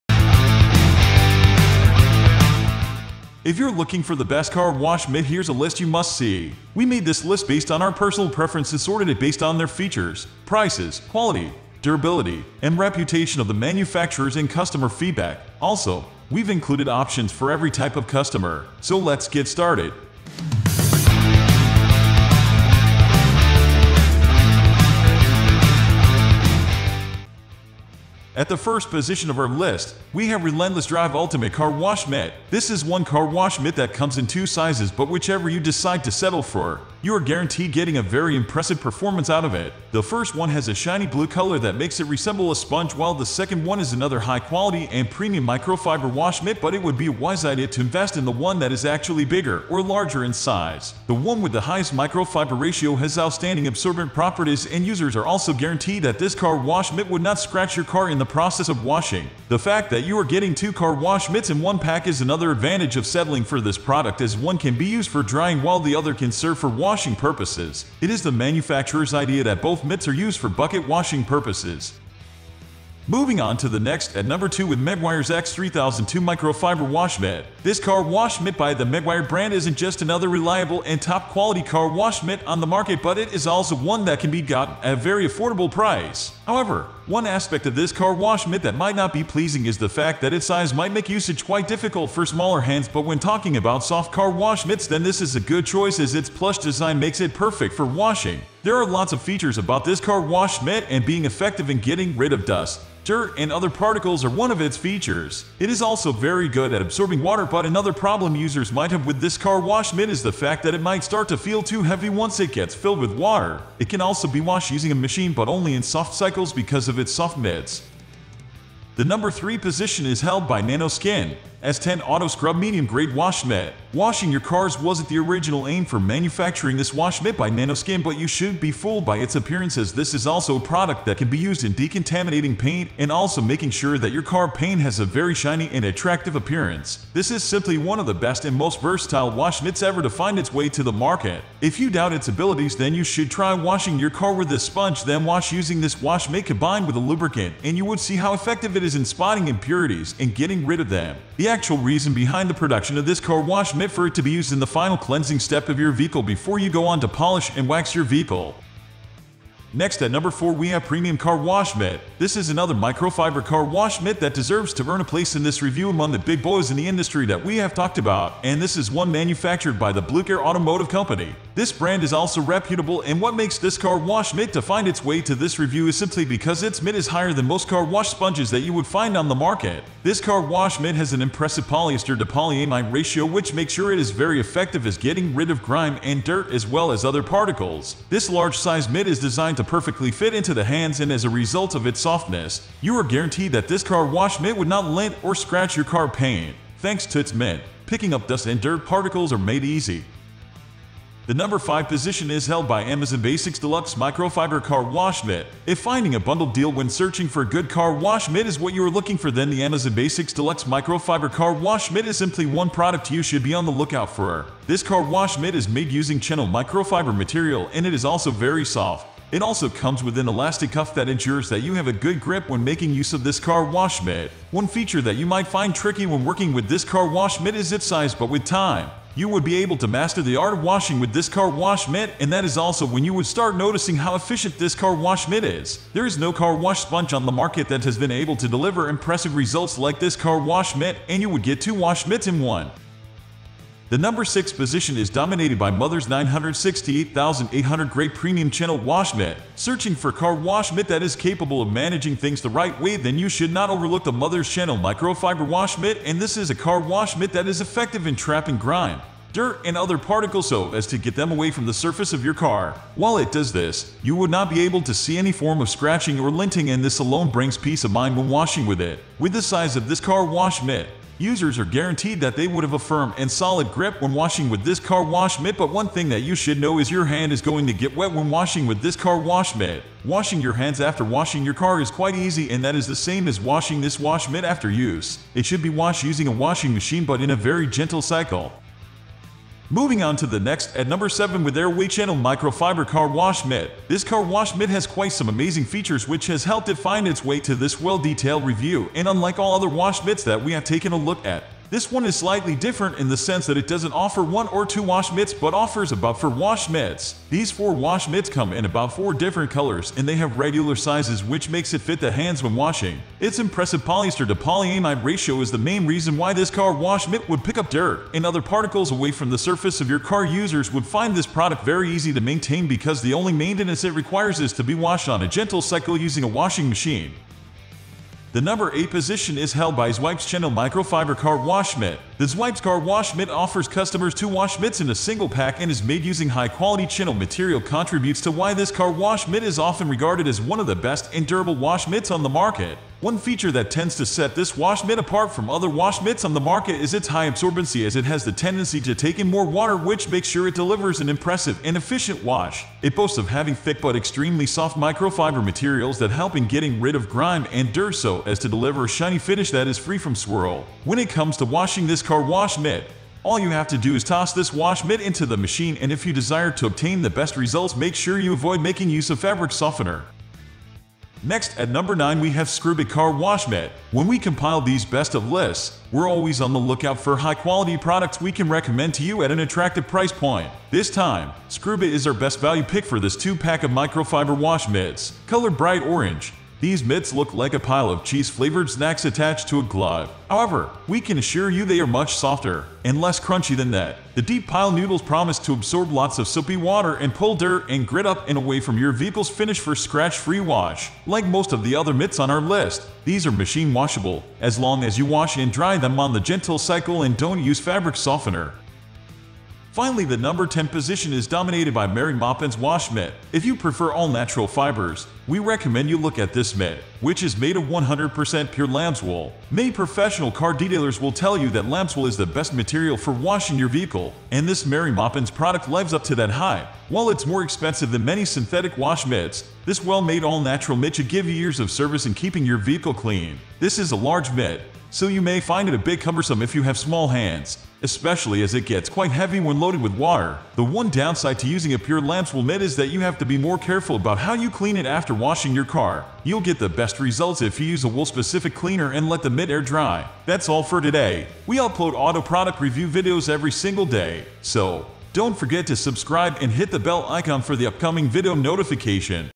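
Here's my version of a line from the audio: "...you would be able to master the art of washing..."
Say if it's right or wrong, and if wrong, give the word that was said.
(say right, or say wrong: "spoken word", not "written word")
right.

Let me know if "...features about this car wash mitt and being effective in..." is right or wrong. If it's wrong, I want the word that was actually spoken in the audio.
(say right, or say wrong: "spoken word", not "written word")
right.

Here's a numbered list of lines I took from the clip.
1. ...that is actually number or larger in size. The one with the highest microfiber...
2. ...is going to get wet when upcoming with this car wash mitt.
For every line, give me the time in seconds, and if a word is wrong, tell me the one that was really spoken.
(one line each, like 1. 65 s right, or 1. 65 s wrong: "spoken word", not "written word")
1. 48 s wrong: "bigger", not "number"
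2. 277 s wrong: "washing", not "upcoming".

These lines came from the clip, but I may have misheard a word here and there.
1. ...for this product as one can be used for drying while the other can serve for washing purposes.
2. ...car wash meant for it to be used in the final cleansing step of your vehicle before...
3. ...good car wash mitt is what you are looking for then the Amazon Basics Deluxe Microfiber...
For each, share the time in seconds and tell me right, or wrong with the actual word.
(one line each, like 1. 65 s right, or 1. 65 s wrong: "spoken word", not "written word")
1. 63 s right
2. 153 s right
3. 207 s right.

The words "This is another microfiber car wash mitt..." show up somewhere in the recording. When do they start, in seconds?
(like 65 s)
162 s.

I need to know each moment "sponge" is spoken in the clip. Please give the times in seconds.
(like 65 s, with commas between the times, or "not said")
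42 s, 144 s, 178 s, 236 s.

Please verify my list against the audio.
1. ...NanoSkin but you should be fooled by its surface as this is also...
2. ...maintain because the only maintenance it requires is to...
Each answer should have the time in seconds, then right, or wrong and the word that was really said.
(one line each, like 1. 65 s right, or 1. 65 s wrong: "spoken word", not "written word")
1. 127 s wrong: "appearance", not "surface"
2. 322 s right.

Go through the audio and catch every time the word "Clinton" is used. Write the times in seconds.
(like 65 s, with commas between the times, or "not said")
not said.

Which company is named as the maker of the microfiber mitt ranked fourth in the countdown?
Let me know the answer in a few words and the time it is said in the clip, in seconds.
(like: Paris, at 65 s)
Blue Care Automotive, at 170 s.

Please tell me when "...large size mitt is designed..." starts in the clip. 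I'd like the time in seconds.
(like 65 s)
188 s.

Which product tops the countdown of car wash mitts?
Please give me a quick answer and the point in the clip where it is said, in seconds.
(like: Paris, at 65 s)
Relentless Drive Ultimate Car Wash Mitt, at 30 s.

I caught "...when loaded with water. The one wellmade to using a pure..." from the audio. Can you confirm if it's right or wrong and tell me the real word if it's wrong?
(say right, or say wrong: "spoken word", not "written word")
wrong: "downside", not "wellmade".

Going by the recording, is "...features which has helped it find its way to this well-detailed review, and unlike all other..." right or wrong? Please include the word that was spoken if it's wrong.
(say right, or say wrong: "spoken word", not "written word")
right.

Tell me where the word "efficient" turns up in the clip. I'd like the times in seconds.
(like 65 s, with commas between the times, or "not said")
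234 s, 351 s.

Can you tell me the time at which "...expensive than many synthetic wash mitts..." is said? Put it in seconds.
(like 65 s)
427 s.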